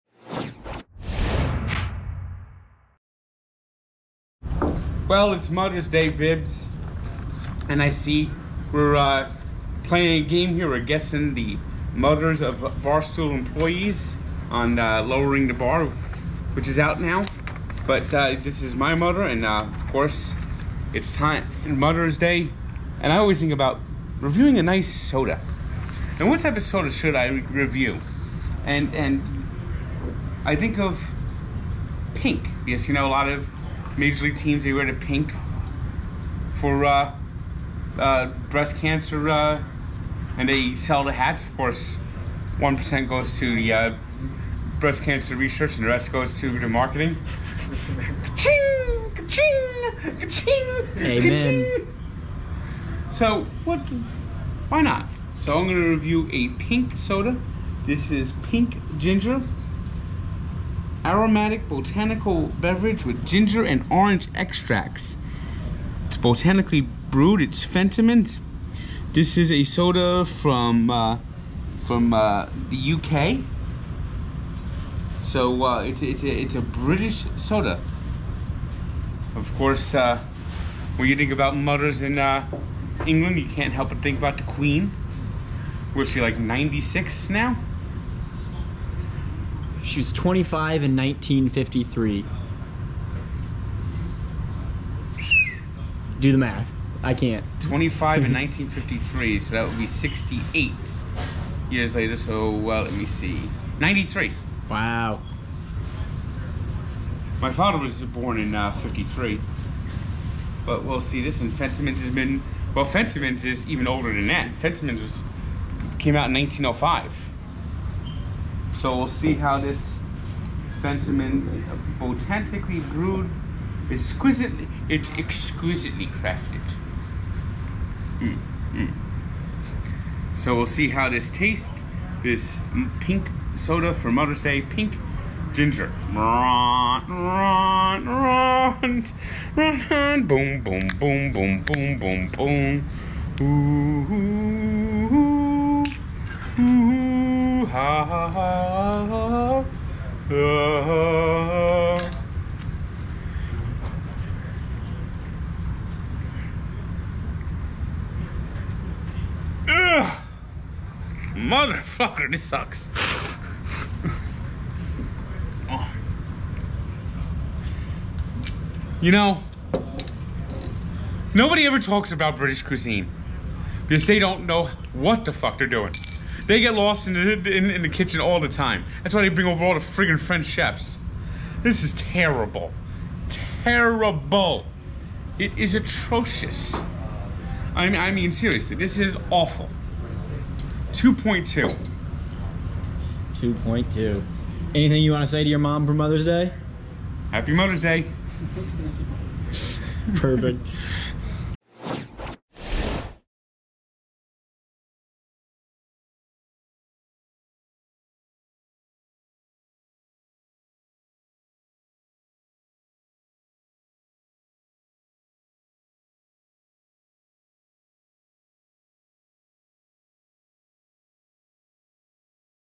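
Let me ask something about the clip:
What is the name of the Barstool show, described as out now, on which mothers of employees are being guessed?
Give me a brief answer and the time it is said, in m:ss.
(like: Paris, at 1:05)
Lowering the Bar, at 0:15.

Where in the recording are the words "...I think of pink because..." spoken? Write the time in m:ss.
0:30.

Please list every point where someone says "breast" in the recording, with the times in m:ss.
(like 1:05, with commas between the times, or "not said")
0:38, 0:44.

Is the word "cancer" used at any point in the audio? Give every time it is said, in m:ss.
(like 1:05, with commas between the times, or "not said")
0:38, 0:45.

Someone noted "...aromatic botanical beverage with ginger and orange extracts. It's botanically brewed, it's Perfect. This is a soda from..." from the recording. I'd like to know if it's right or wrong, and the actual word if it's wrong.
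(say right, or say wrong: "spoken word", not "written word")
wrong: "Fentimans", not "Perfect".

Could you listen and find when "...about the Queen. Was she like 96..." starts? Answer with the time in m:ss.
1:24.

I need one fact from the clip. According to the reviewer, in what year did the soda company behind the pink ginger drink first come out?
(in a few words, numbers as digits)
1905.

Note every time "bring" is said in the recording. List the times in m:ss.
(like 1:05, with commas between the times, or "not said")
2:59.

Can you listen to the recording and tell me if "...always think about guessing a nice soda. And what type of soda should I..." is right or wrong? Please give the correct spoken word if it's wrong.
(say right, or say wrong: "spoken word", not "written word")
wrong: "reviewing", not "guessing".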